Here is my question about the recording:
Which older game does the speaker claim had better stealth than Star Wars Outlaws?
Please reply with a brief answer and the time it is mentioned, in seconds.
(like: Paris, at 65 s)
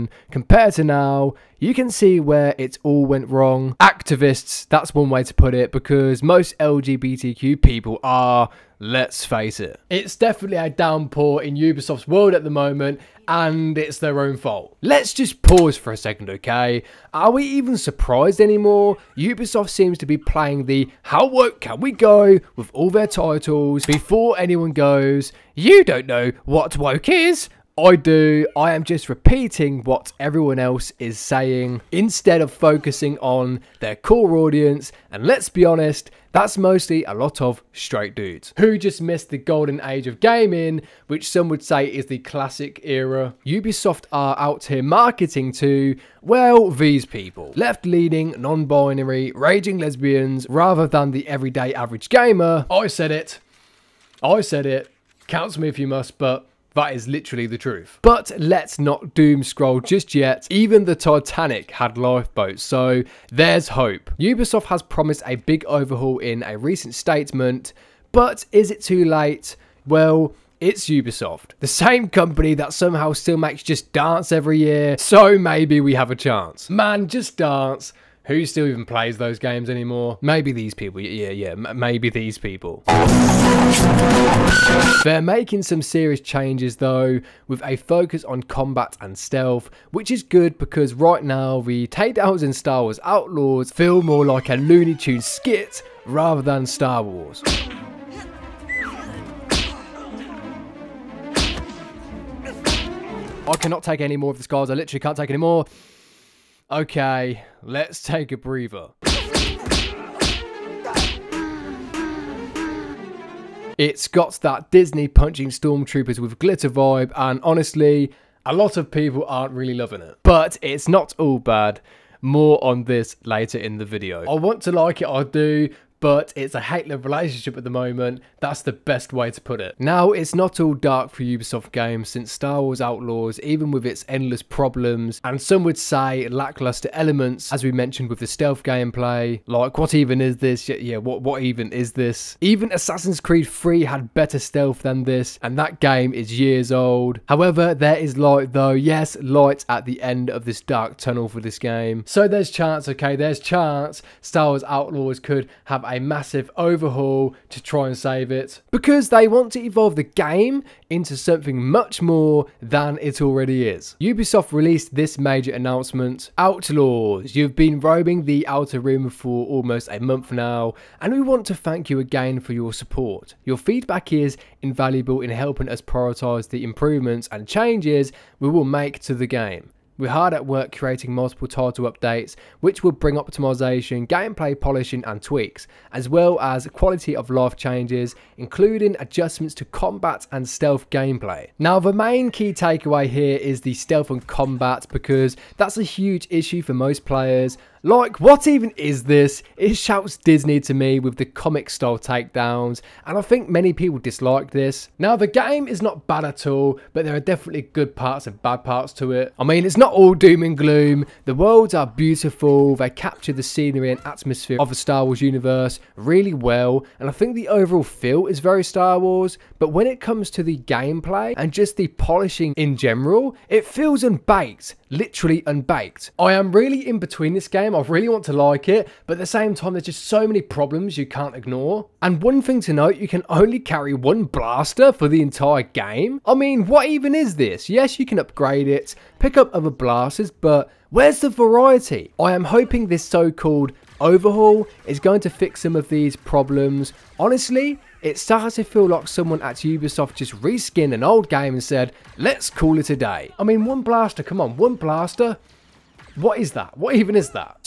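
Assassin's Creed 3, at 142 s.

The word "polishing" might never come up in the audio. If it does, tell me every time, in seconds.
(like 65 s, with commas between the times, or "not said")
184 s, 221 s.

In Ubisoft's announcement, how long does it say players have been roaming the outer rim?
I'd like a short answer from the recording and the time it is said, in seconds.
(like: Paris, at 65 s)
Almost a month, at 169 s.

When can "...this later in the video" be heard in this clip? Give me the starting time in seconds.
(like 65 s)
122 s.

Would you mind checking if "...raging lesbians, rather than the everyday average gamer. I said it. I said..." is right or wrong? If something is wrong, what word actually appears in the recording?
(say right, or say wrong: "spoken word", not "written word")
right.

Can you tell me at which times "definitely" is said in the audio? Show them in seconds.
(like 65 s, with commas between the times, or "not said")
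10 s, 207 s.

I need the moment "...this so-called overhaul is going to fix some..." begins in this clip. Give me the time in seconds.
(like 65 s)
242 s.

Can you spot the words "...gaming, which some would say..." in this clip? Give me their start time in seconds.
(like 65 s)
40 s.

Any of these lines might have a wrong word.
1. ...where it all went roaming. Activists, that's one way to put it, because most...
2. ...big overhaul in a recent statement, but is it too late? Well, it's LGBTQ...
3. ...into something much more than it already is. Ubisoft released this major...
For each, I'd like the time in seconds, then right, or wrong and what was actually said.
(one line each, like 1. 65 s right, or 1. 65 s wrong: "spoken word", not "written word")
1. 2 s wrong: "wrong", not "roaming"
2. 65 s wrong: "Ubisoft", not "LGBTQ"
3. 160 s right.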